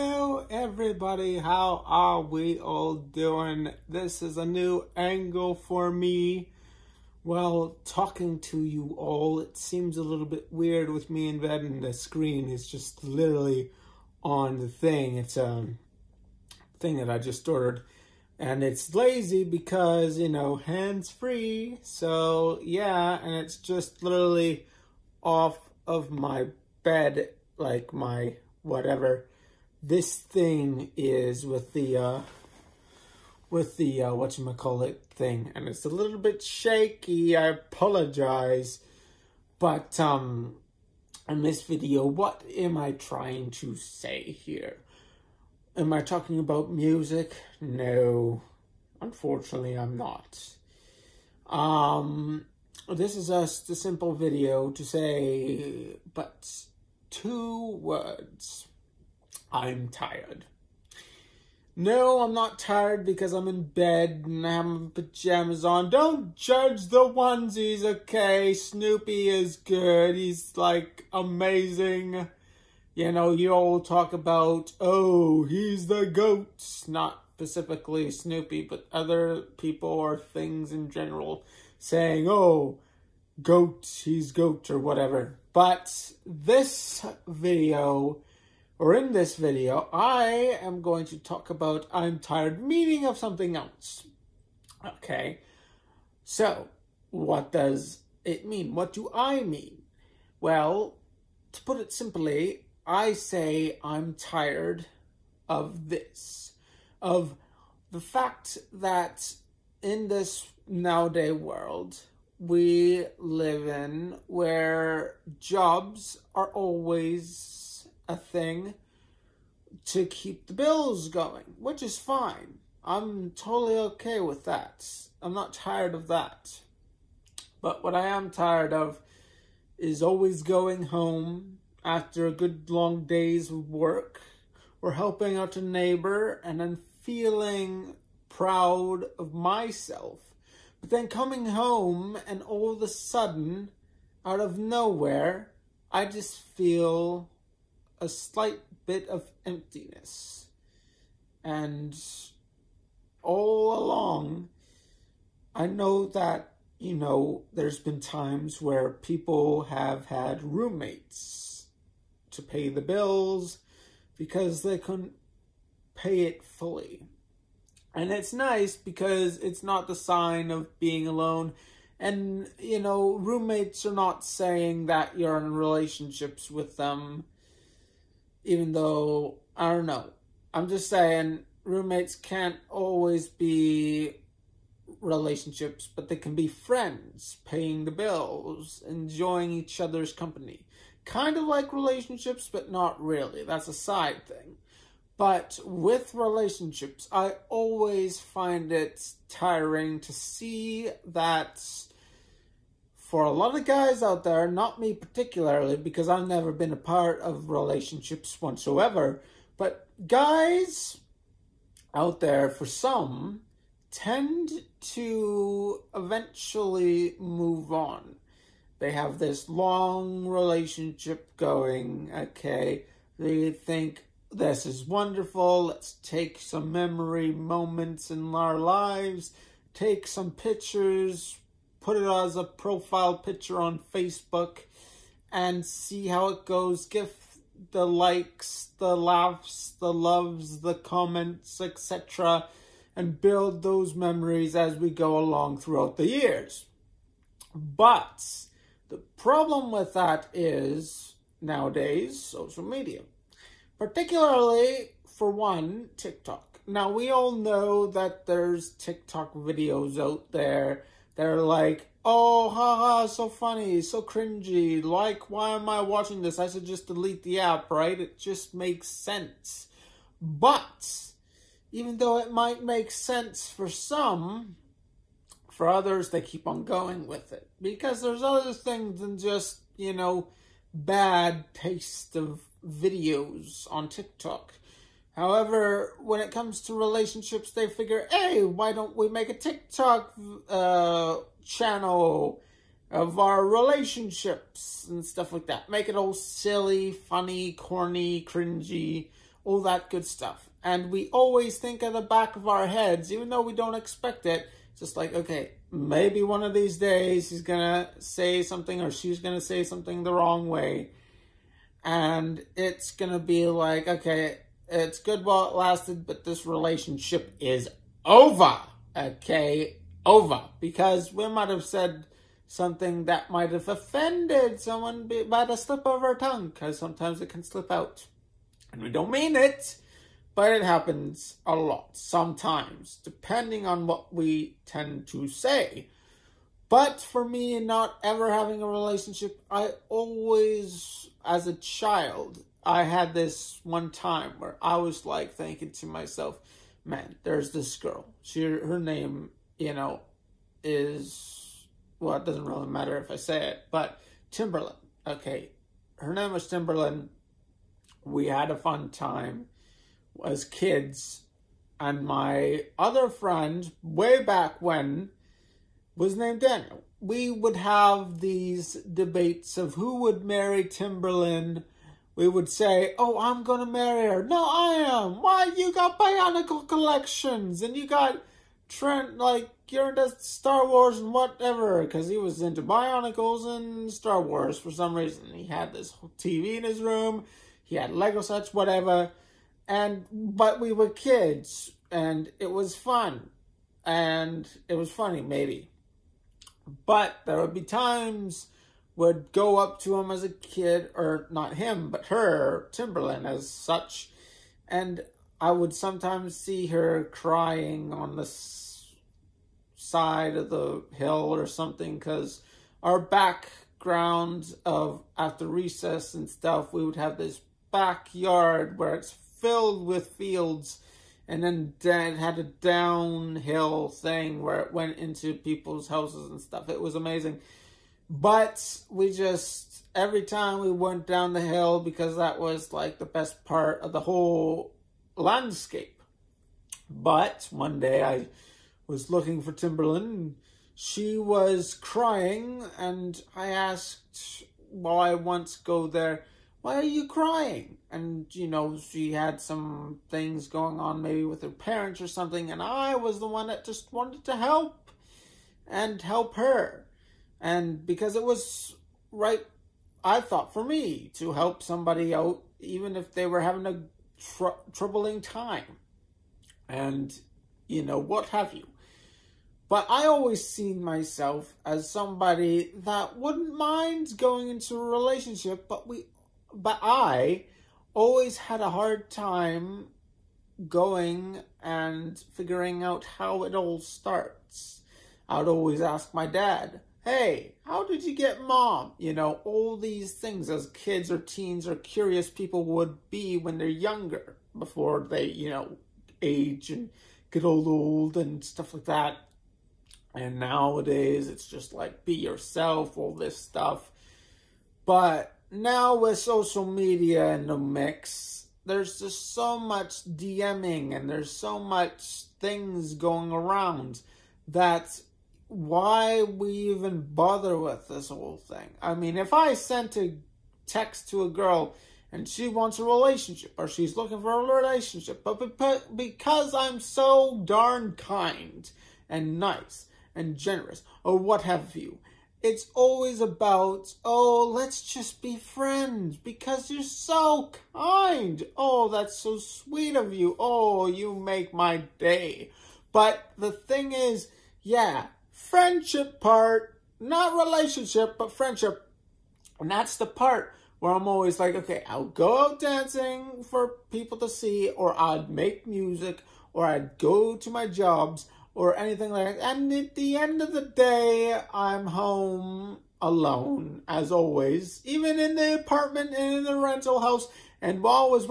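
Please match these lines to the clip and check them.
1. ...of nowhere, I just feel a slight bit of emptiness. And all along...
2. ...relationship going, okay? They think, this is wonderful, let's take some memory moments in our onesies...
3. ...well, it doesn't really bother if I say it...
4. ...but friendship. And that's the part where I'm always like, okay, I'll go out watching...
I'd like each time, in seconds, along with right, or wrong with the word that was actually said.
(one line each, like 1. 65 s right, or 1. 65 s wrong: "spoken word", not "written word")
1. 144 s right
2. 220 s wrong: "lives", not "onesies"
3. 352 s wrong: "matter", not "bother"
4. 548 s wrong: "dancing", not "watching".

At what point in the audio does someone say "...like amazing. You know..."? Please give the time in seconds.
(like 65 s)
70 s.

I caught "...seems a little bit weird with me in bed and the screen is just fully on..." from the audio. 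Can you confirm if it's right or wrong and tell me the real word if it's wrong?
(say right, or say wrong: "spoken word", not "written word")
wrong: "literally", not "fully".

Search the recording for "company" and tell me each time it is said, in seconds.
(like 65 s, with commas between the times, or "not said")
190 s.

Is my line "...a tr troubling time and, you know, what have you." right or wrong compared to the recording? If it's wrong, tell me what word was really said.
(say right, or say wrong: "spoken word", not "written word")
right.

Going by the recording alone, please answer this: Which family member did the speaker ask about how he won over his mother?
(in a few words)
dad.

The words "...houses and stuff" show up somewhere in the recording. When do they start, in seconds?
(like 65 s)
425 s.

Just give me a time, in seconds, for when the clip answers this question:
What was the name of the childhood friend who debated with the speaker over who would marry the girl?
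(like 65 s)
366 s.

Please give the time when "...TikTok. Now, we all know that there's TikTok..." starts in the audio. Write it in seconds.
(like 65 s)
255 s.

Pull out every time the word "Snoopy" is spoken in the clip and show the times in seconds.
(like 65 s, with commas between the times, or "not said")
68 s, 78 s.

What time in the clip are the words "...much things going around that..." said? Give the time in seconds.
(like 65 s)
511 s.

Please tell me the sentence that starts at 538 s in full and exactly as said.
Oh, that's so sweet of you.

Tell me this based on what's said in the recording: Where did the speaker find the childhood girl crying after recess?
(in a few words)
side of the hill.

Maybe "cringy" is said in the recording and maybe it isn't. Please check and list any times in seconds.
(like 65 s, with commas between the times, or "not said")
264 s, 298 s.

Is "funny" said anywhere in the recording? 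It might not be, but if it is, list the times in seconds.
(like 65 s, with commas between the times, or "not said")
263 s, 296 s, 394 s.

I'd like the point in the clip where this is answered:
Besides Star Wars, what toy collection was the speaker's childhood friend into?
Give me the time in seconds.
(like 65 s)
382 s.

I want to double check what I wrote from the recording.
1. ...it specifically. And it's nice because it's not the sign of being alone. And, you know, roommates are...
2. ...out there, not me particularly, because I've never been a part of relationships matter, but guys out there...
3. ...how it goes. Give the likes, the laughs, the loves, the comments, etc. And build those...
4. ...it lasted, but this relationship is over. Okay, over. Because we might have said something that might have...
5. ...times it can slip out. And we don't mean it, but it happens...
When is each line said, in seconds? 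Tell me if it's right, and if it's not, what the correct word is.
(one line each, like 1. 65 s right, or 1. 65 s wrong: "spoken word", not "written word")
1. 166 s wrong: "fully", not "specifically"
2. 204 s wrong: "whatsoever", not "matter"
3. 236 s right
4. 315 s right
5. 326 s wrong: "sometimes", not "times".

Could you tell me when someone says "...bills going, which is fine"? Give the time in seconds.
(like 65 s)
120 s.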